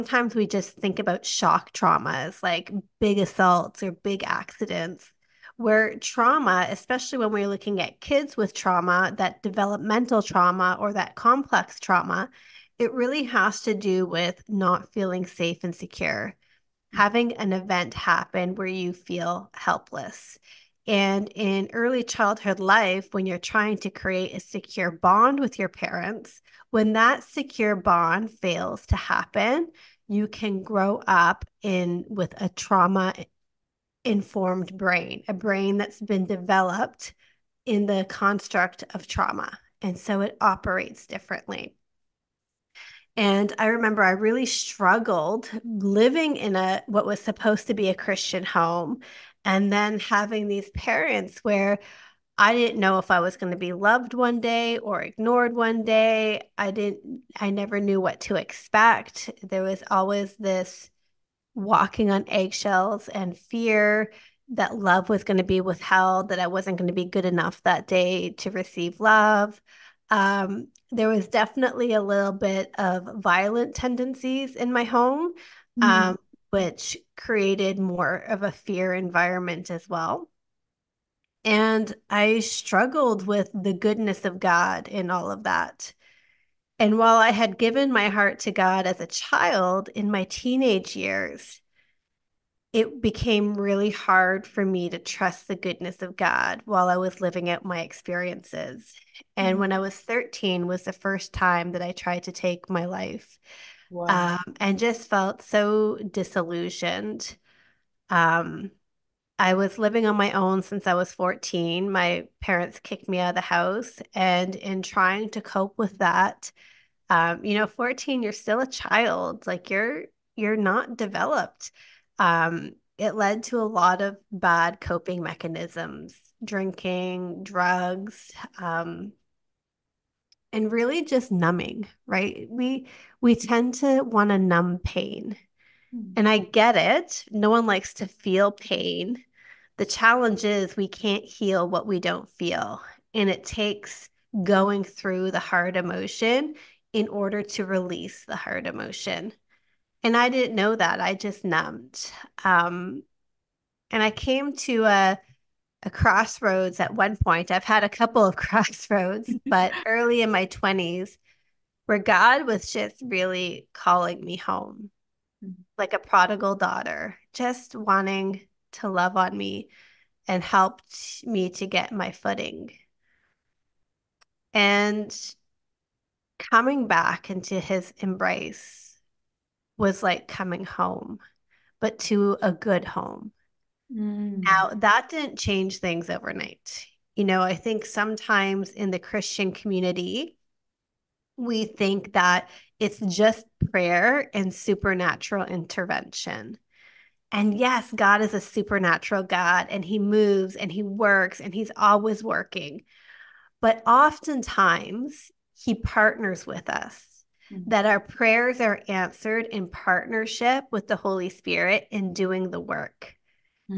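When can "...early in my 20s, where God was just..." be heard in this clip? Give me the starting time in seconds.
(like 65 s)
159 s.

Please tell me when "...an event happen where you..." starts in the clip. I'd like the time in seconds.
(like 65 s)
17 s.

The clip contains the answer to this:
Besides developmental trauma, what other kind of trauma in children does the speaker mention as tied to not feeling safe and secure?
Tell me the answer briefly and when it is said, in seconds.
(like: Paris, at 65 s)
complex trauma, at 11 s.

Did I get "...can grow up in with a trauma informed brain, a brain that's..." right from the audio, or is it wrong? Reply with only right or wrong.
right.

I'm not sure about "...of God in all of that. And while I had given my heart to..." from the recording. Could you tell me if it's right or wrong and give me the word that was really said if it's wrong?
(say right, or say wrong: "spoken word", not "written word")
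right.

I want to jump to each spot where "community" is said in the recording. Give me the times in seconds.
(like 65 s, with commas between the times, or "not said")
189 s.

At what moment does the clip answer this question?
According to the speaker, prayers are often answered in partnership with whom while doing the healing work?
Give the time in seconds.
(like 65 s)
210 s.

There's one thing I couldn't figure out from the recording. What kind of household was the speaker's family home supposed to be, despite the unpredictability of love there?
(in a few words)
Christian home.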